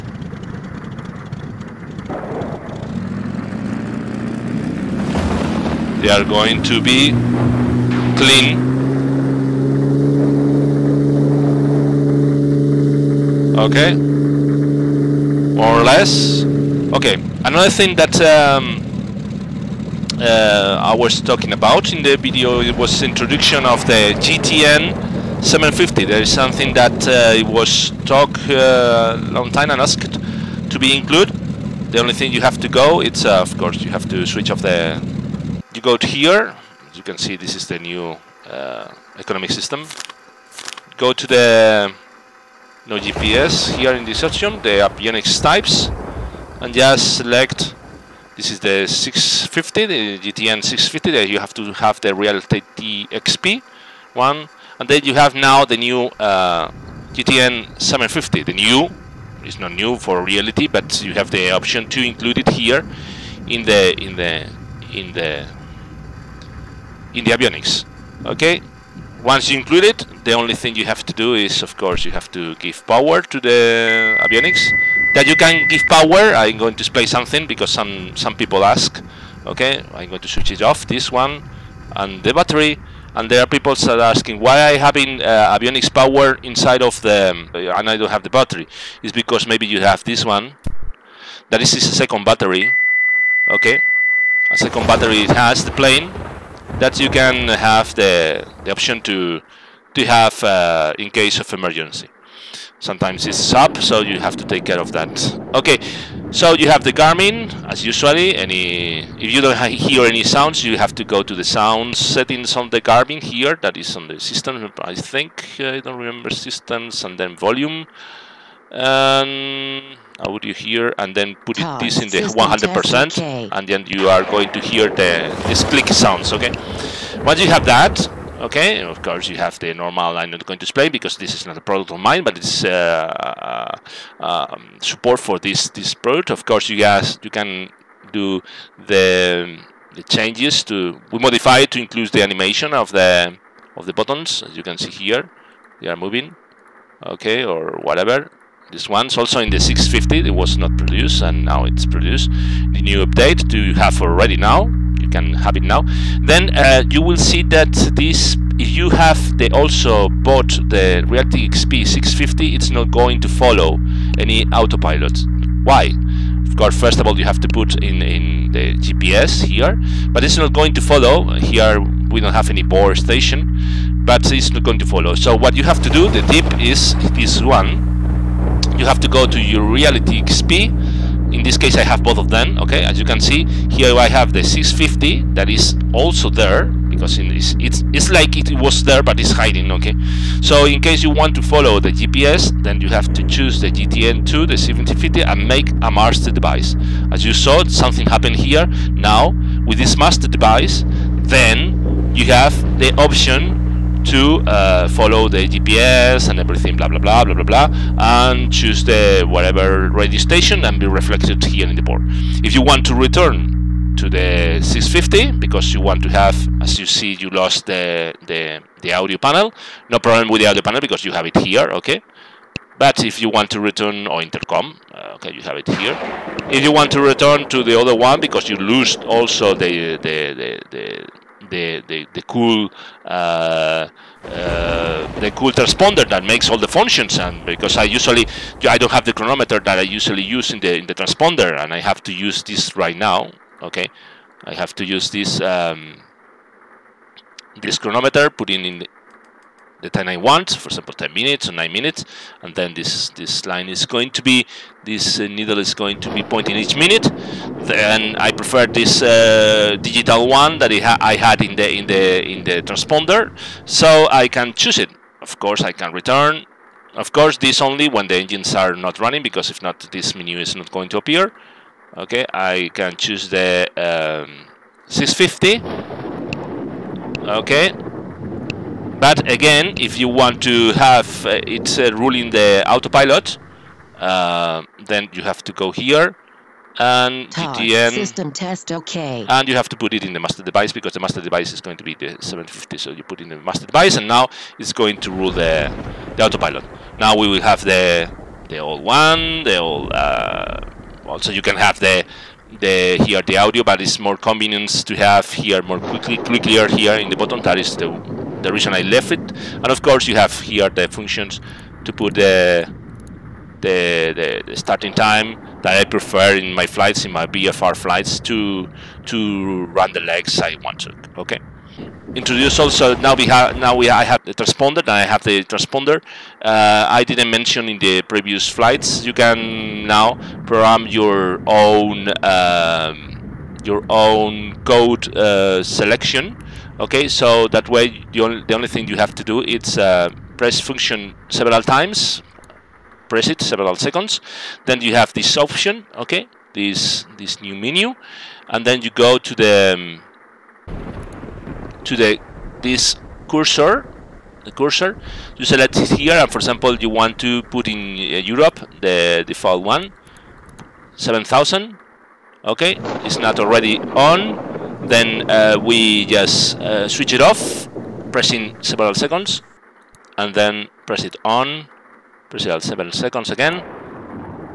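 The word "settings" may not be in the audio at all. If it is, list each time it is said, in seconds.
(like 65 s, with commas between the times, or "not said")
111 s.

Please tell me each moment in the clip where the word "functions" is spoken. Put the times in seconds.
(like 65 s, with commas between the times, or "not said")
236 s, 310 s, 340 s.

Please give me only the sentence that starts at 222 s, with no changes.
But if you want to return or intercom, uh, okay, you have it here.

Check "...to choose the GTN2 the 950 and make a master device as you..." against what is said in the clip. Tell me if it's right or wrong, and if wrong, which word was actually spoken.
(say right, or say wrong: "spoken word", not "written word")
wrong: "750", not "950".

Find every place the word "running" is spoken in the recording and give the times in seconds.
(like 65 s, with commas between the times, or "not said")
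268 s.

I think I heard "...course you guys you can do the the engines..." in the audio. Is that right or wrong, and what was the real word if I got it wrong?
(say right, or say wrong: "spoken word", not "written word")
wrong: "changes", not "engines".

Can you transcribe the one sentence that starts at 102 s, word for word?
Sometimes it's up, so you have to take care of that.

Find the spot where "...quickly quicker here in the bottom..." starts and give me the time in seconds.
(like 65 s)
305 s.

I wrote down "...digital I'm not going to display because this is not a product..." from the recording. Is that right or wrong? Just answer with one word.
wrong.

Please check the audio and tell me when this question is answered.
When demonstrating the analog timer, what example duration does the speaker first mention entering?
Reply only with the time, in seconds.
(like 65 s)
250 s.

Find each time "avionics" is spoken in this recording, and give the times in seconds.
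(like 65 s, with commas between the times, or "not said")
44 s, 67 s, 74 s, 85 s.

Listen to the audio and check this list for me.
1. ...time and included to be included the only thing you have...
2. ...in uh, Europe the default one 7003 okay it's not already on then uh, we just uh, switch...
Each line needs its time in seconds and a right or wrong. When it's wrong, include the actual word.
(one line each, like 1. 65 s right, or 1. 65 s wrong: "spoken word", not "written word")
1. 29 s wrong: "asked", not "included"
2. 357 s wrong: "7000", not "7003".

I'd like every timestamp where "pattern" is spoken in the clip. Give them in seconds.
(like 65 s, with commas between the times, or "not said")
not said.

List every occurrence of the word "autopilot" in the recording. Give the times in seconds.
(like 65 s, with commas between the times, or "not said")
164 s, 282 s, 296 s.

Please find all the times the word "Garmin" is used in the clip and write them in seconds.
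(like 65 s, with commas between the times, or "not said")
106 s, 112 s.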